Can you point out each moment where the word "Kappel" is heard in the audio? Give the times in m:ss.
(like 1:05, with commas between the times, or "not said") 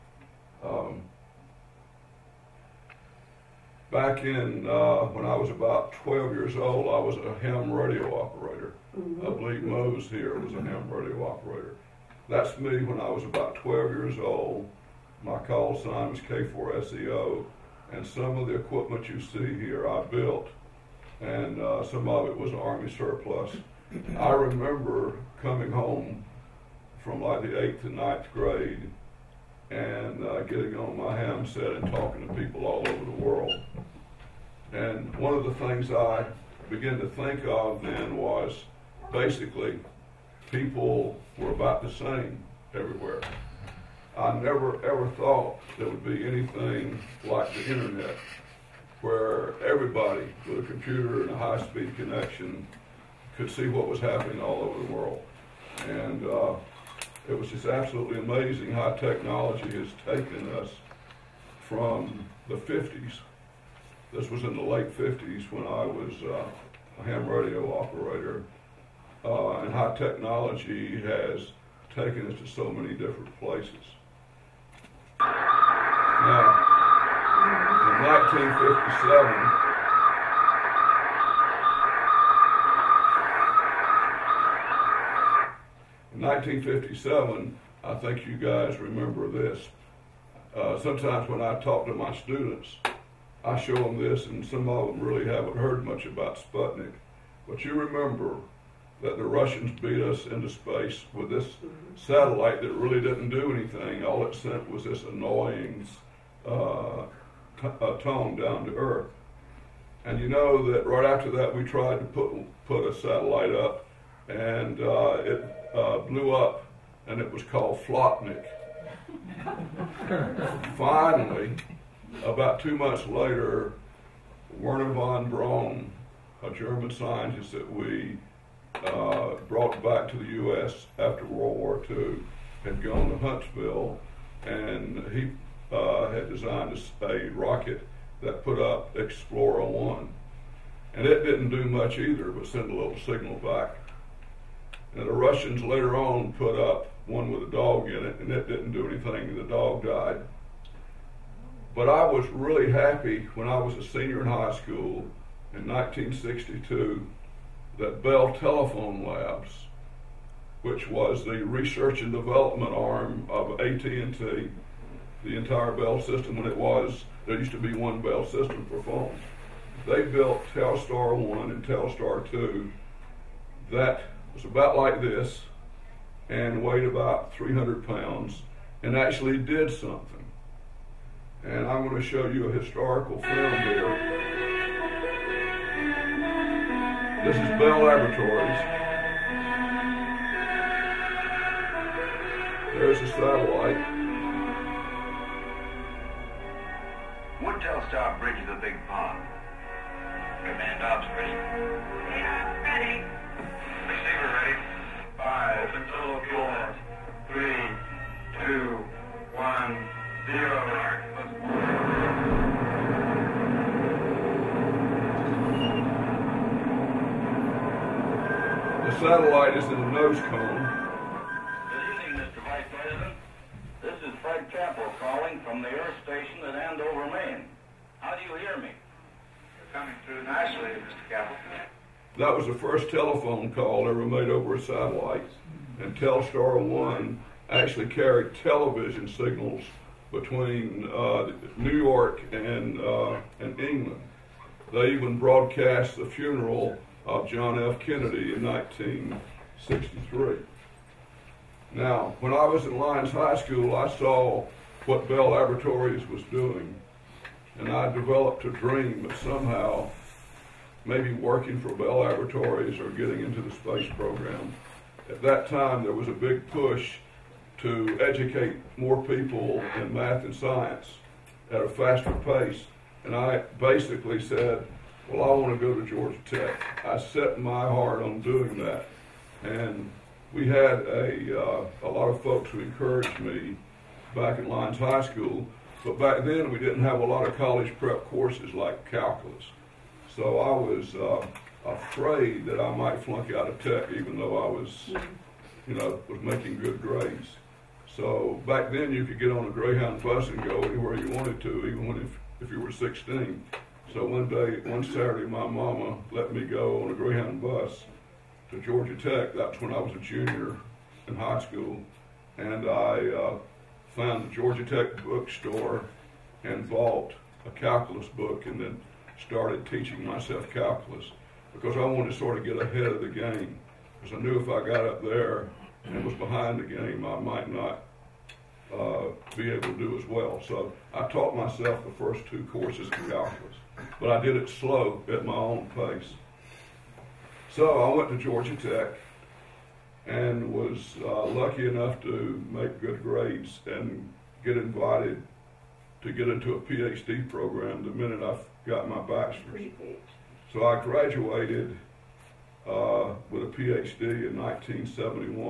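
3:44, 3:51.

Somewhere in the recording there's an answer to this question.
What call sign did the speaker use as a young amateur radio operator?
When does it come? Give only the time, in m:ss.
0:16.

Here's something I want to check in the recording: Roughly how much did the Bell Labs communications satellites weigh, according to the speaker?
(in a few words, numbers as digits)
300 pounds.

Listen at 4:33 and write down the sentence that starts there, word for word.
And I basically said, well, I want to go to Georgia Tech.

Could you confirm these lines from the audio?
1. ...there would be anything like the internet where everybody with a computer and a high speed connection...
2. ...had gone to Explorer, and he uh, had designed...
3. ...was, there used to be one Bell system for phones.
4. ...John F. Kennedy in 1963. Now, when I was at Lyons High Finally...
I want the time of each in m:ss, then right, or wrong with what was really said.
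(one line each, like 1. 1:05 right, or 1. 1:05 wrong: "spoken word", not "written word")
1. 0:45 right
2. 2:12 wrong: "Huntsville", not "Explorer"
3. 2:46 right
4. 4:07 wrong: "School", not "Finally".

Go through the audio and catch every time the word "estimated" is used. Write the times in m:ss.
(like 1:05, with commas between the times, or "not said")
not said.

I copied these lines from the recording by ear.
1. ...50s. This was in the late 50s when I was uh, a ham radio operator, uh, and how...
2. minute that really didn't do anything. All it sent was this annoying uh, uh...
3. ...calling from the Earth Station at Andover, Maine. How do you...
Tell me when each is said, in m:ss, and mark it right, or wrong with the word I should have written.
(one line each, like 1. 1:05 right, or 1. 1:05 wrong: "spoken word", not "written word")
1. 1:02 right
2. 1:42 wrong: "satellite", not "minute"
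3. 3:44 right.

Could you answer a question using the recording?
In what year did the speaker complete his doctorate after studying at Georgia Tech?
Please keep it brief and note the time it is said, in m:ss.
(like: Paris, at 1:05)
1971, at 5:54.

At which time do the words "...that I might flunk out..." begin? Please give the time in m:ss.
4:52.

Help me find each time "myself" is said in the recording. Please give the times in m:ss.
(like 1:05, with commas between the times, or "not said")
5:20, 5:31.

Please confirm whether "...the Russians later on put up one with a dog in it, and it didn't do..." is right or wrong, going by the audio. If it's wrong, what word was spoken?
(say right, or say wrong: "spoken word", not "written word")
right.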